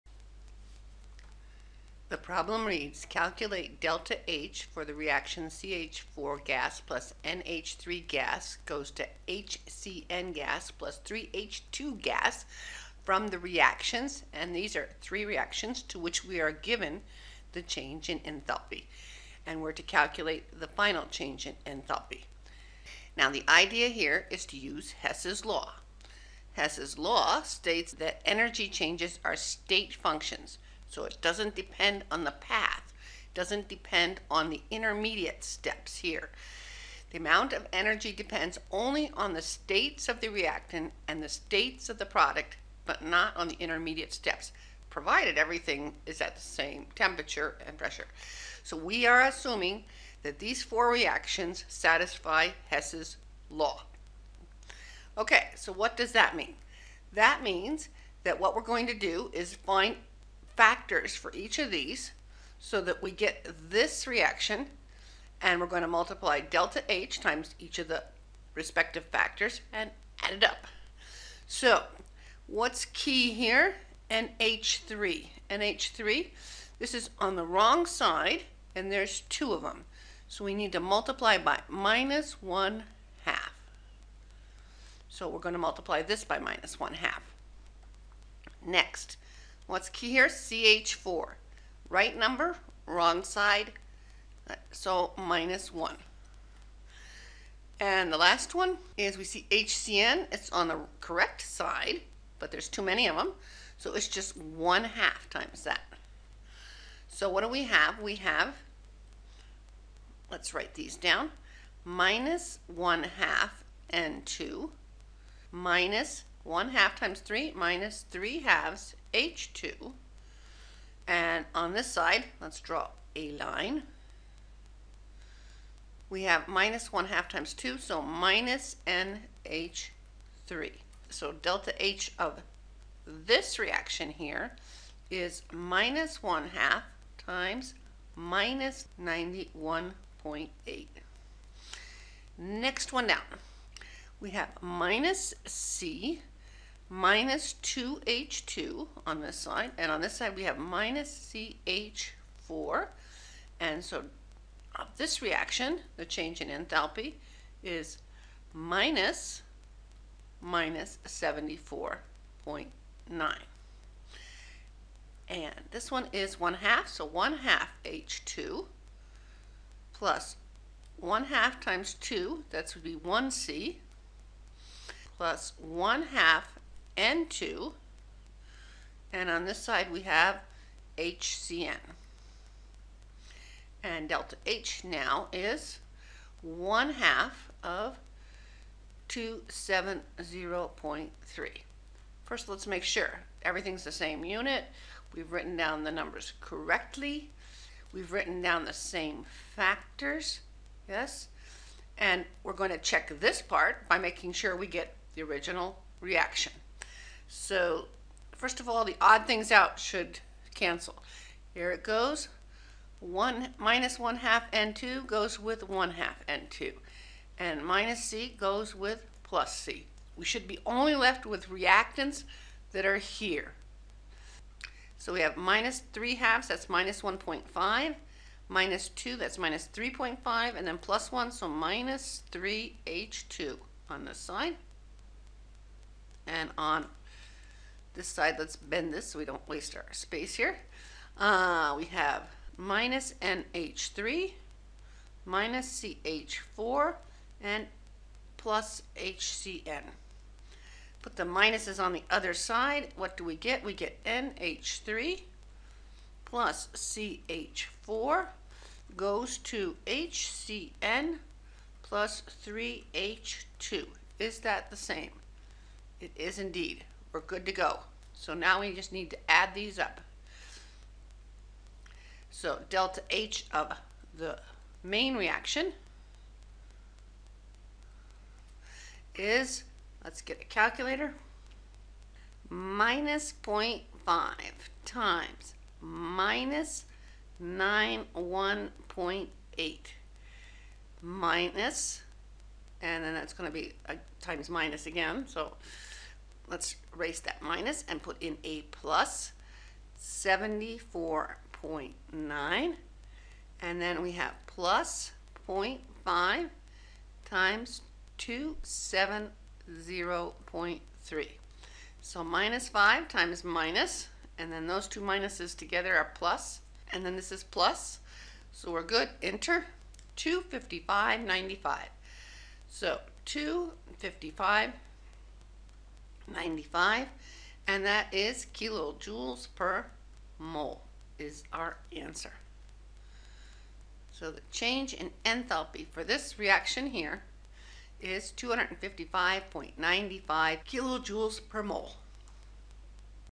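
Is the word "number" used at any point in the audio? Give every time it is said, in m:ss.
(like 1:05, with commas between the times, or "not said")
1:32, 3:15.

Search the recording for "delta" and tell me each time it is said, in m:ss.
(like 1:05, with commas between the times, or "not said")
0:03, 1:06, 2:11, 3:04, 4:32.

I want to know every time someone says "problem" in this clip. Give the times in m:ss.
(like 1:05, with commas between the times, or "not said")
0:02.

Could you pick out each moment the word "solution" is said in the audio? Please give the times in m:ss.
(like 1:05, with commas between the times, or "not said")
not said.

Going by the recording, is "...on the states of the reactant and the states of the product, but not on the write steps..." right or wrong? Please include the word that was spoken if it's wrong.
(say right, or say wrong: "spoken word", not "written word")
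wrong: "intermediate", not "write".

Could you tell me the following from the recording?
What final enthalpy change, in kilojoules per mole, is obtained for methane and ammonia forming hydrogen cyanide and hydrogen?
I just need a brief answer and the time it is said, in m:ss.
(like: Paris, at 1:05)
255.95 kJ/mol, at 5:38.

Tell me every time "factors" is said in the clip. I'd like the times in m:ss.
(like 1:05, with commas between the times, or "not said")
1:00, 1:09, 3:19.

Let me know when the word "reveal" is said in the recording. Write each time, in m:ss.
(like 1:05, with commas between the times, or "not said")
not said.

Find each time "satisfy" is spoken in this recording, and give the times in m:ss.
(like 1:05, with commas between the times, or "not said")
0:51.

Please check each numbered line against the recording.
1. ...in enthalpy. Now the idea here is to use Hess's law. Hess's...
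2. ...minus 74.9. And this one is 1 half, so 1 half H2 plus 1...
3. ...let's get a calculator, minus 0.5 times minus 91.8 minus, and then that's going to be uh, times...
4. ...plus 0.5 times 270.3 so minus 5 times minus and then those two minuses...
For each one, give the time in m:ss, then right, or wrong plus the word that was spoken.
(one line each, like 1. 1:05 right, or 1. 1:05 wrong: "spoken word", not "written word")
1. 0:21 right
2. 2:40 right
3. 4:40 right
4. 5:04 right.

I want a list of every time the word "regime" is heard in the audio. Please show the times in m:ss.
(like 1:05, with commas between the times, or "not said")
not said.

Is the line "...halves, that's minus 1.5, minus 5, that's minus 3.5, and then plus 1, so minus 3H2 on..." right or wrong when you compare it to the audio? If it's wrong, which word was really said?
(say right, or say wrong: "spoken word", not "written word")
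wrong: "2", not "5".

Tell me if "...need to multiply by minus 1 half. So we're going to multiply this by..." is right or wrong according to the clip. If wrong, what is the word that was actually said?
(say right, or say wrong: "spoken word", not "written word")
right.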